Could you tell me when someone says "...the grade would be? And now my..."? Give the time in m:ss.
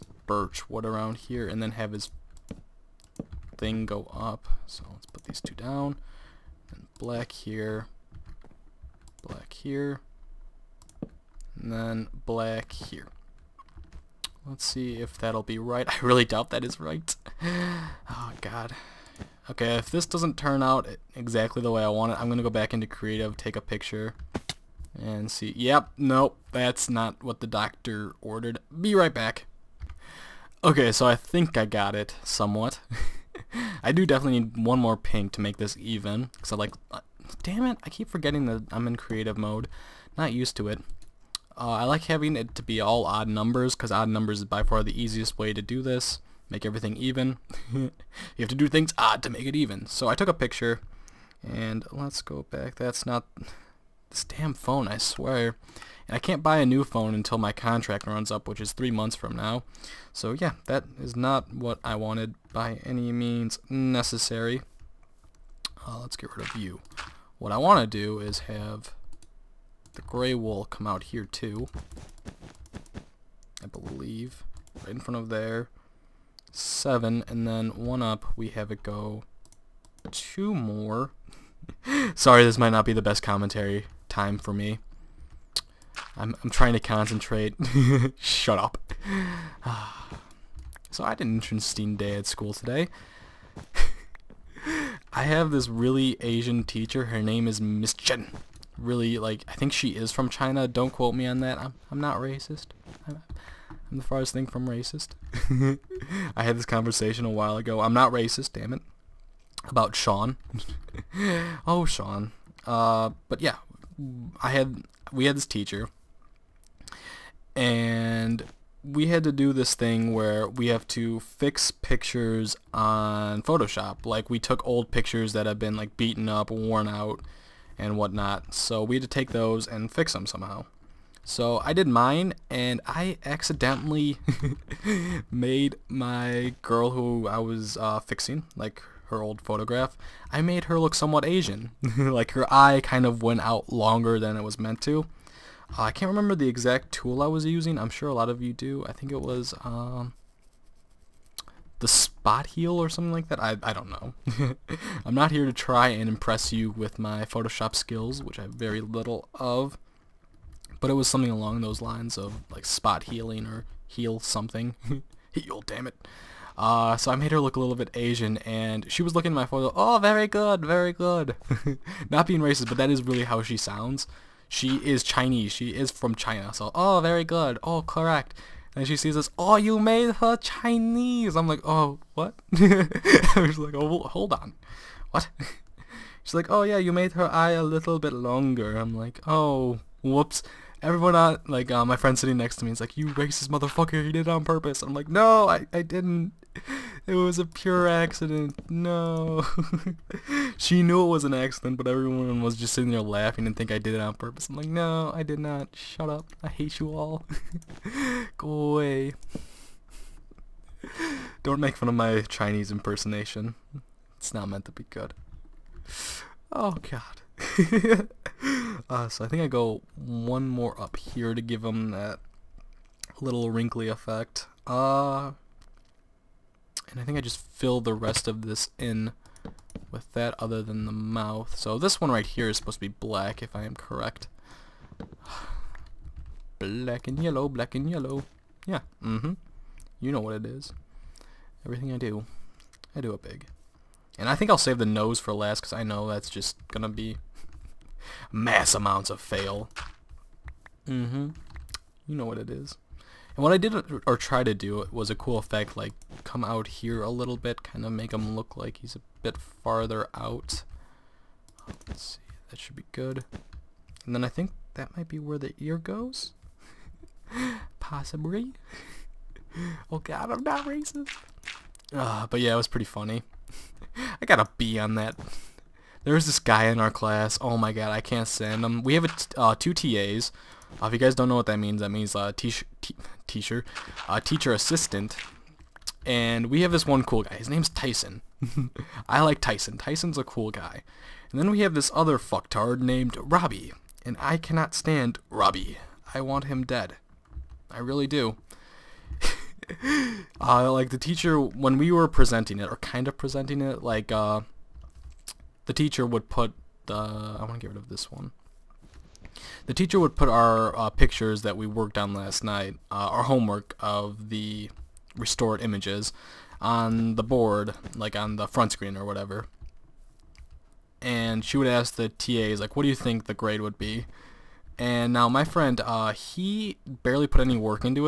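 5:23.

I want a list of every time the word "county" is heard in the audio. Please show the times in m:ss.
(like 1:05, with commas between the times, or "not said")
not said.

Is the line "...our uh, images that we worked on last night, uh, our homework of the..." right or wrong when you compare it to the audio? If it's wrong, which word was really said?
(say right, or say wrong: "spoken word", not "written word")
wrong: "pictures", not "images".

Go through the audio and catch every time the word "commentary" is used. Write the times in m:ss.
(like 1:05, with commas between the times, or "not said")
1:23.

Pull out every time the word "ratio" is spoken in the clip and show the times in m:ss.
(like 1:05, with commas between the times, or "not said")
not said.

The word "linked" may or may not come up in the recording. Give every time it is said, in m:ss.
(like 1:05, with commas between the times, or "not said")
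not said.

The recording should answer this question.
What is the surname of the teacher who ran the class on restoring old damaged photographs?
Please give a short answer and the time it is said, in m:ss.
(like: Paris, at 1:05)
Chen, at 1:37.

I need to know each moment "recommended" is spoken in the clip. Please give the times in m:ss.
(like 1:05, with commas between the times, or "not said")
not said.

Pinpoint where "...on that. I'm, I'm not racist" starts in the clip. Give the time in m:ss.
1:41.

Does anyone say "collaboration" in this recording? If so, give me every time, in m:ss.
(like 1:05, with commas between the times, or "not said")
not said.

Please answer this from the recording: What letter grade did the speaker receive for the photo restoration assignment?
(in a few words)
B.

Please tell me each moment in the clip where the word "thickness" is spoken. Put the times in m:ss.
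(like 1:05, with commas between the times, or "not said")
not said.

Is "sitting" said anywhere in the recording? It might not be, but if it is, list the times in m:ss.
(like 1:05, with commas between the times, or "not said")
3:12, 3:22.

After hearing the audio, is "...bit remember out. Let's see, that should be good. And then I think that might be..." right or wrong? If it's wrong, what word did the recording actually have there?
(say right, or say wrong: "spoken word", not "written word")
wrong: "farther", not "remember".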